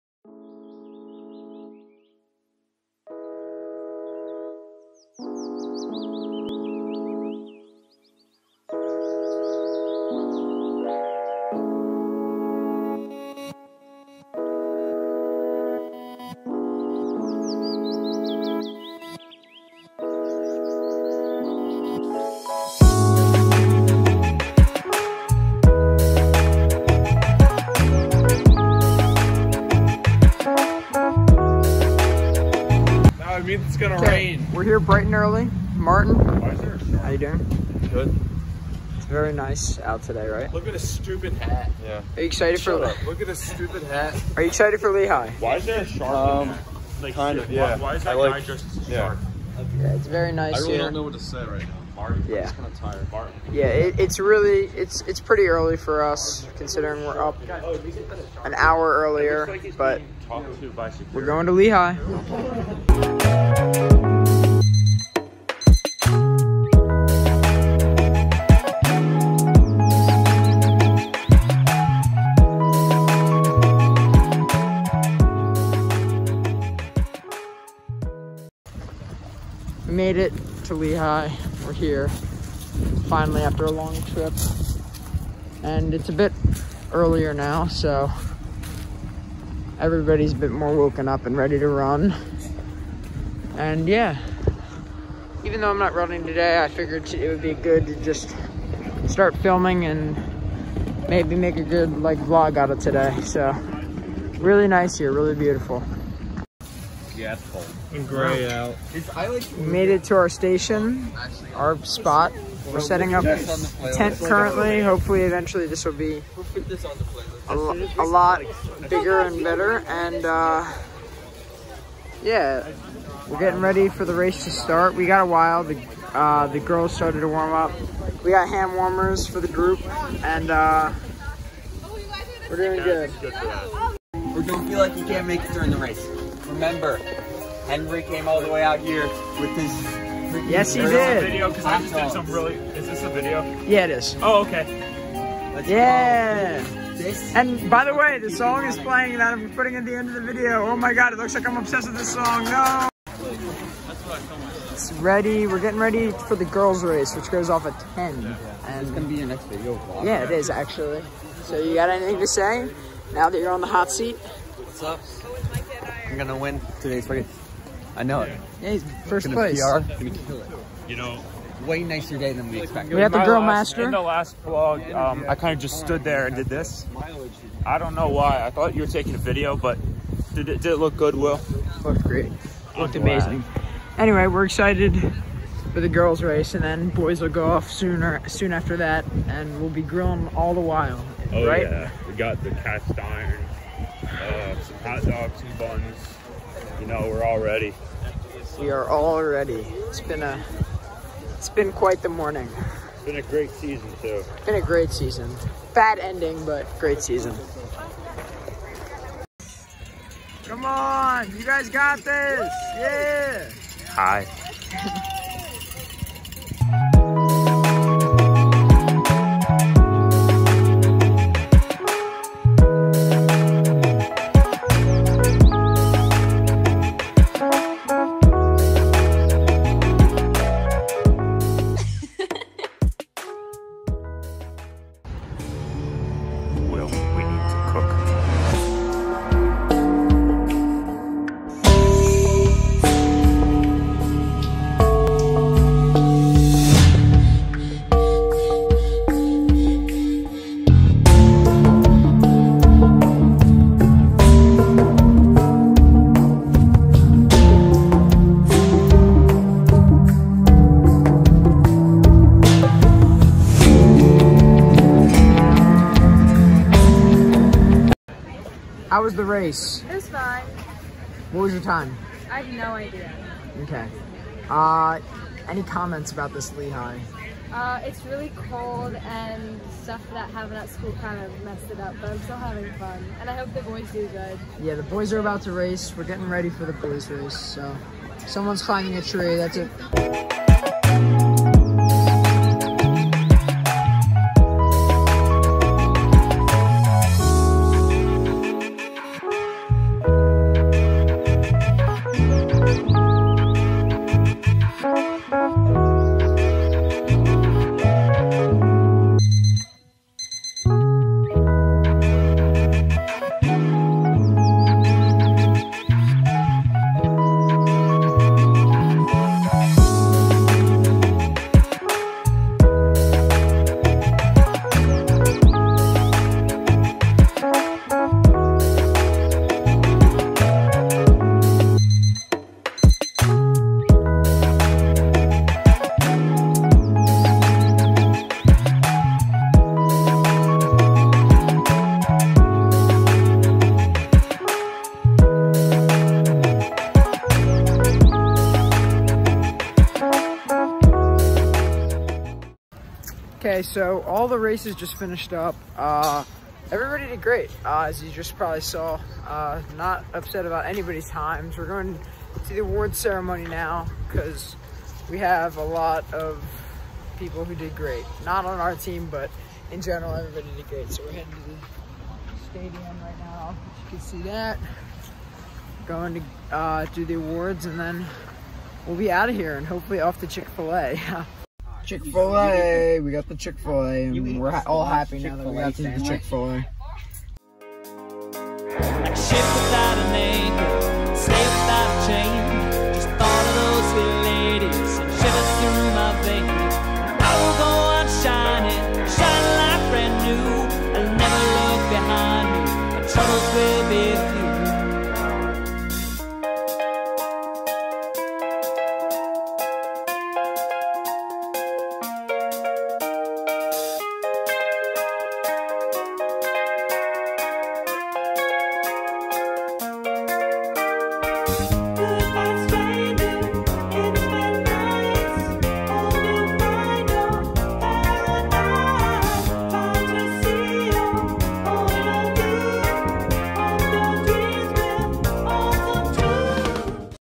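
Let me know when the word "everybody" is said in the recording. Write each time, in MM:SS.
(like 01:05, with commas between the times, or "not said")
01:29, 05:56, 06:10.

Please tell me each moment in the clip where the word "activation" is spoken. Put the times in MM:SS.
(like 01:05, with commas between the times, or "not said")
not said.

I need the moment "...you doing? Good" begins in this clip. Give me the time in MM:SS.
00:37.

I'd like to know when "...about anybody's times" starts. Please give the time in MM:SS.
06:00.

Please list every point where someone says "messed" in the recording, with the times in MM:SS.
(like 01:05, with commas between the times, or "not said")
04:41.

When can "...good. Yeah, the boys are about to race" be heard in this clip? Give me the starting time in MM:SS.
04:44.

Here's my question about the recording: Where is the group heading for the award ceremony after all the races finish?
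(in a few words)
the stadium.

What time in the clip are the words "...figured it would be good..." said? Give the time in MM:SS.
01:36.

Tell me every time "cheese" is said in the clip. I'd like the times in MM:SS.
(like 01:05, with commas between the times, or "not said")
not said.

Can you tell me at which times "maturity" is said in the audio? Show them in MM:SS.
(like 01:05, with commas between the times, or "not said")
not said.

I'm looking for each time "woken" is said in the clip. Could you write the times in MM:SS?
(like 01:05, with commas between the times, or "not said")
01:30.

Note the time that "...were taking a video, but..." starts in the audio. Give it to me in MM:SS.
02:58.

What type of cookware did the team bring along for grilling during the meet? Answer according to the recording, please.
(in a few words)
cast iron.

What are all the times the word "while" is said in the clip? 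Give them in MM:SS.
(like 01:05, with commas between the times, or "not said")
02:05, 03:10.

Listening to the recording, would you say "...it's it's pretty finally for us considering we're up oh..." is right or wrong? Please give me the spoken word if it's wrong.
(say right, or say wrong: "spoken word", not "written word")
wrong: "early", not "finally".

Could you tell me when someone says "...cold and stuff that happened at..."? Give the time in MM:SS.
04:38.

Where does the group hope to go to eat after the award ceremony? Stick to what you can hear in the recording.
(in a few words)
Chick-fil-A.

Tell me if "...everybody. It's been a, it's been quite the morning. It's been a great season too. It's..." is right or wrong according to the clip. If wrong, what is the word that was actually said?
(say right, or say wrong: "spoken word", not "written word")
wrong: "ready", not "everybody".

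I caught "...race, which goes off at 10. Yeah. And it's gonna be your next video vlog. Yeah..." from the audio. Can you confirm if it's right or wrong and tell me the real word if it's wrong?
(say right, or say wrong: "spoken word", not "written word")
right.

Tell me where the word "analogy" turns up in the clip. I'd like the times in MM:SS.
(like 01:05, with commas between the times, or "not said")
not said.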